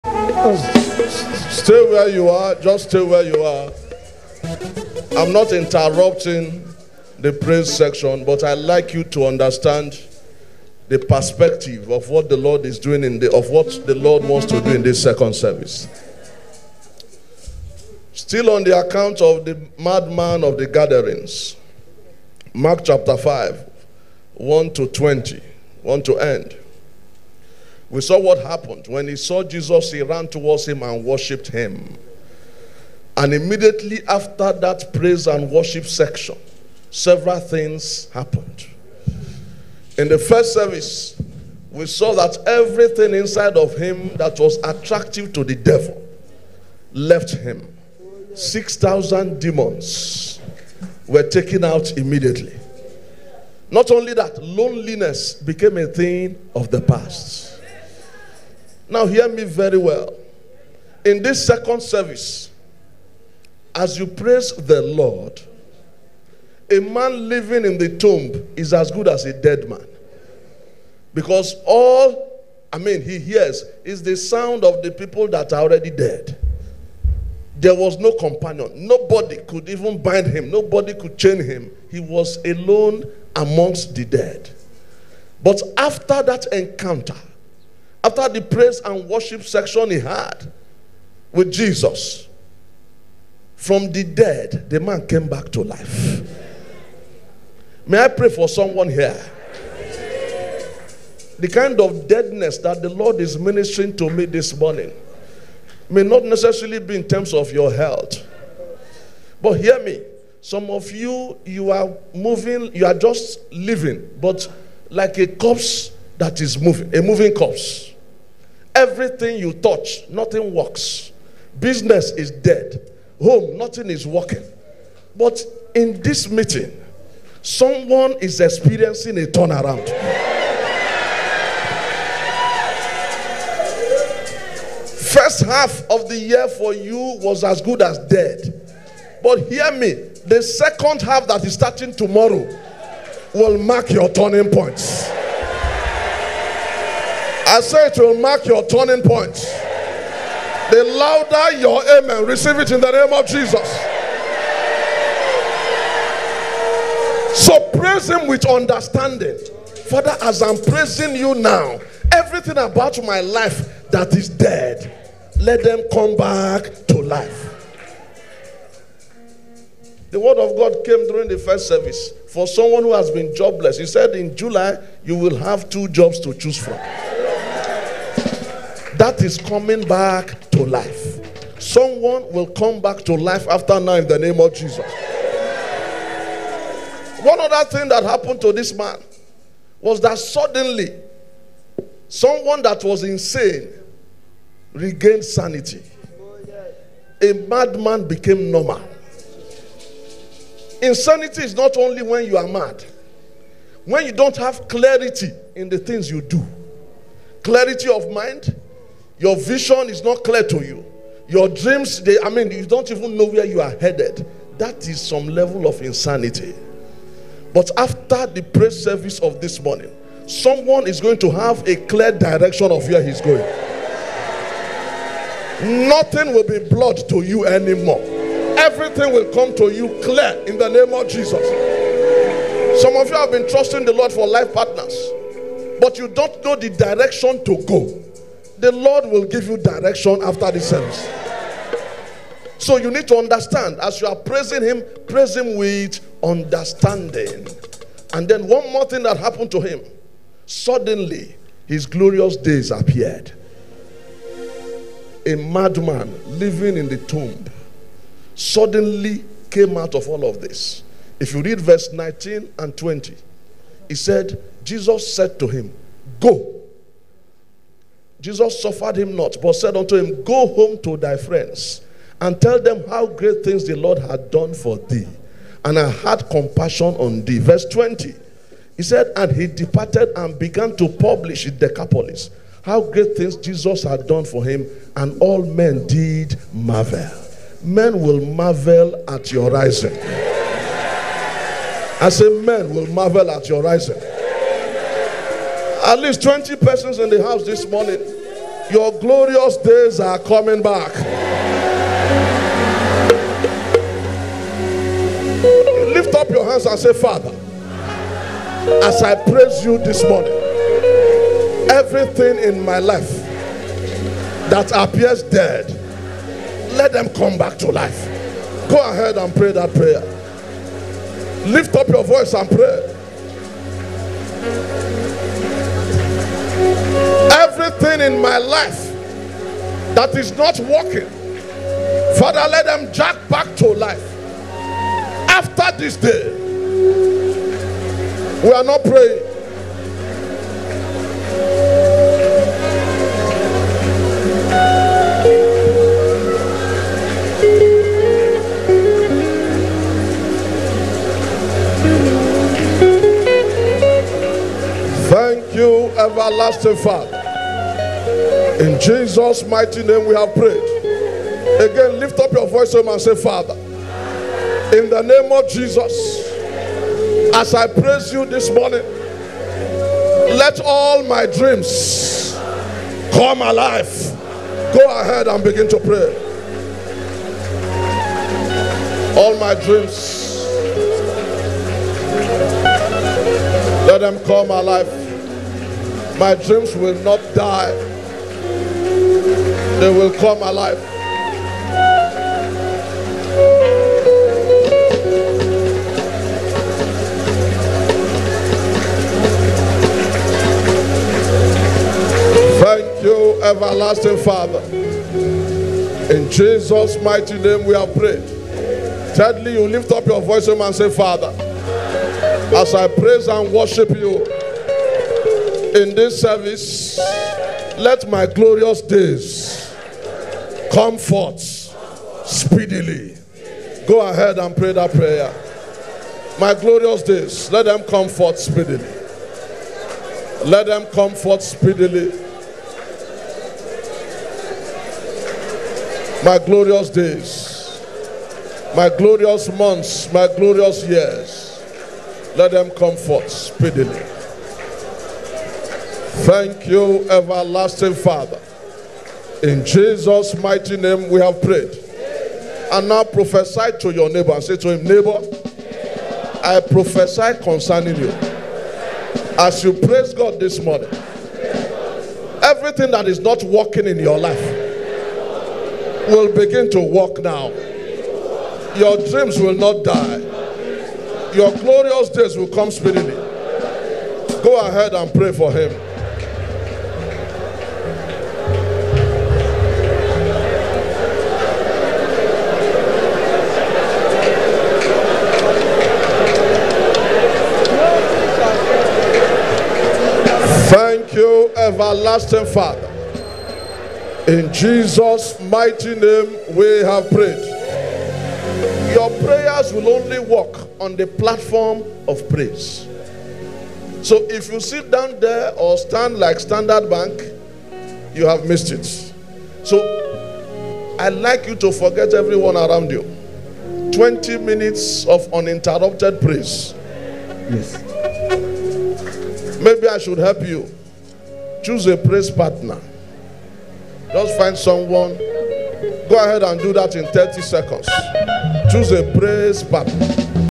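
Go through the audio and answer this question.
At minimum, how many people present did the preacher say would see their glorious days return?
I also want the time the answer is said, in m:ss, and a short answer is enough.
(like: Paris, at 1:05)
20, at 4:56.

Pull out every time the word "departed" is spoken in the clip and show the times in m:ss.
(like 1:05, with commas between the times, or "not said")
4:39.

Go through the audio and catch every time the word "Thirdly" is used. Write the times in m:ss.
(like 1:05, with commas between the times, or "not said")
6:49.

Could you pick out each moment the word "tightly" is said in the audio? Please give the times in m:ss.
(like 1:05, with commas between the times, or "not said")
not said.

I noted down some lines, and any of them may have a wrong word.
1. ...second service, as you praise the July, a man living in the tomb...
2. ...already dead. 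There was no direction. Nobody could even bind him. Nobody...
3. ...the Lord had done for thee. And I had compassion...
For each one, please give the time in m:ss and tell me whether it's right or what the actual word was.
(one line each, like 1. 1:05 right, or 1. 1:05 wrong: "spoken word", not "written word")
1. 1:01 wrong: "Lord", not "July"
2. 1:15 wrong: "companion", not "direction"
3. 4:33 right.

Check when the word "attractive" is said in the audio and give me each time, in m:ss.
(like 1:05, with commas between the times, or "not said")
0:44.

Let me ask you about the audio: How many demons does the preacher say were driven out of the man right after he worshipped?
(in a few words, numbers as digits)
6,000.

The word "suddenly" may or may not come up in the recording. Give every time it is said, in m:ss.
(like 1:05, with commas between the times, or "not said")
3:10, 4:10, 4:18.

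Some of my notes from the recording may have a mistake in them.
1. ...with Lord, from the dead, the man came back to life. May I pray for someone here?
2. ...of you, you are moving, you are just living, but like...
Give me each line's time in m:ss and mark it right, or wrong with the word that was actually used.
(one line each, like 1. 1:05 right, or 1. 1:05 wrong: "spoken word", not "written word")
1. 1:31 wrong: "Jesus", not "Lord"
2. 1:50 right.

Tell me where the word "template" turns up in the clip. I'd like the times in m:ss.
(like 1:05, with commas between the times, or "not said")
not said.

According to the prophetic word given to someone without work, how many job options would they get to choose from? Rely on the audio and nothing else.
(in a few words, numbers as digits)
2.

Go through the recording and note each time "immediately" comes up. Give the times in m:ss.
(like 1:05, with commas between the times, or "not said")
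0:33, 0:51.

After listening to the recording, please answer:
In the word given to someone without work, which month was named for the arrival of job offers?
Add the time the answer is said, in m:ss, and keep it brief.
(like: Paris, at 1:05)
July, at 2:54.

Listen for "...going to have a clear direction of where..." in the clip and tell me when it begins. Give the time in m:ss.
3:40.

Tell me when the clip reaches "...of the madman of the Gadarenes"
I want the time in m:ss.
0:19.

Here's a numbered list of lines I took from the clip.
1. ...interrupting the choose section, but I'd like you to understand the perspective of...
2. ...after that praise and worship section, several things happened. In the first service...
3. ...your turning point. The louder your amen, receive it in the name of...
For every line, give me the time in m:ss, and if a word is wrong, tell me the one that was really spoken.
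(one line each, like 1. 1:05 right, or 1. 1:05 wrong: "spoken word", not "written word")
1. 0:05 wrong: "praise", not "choose"
2. 0:34 right
3. 2:28 right.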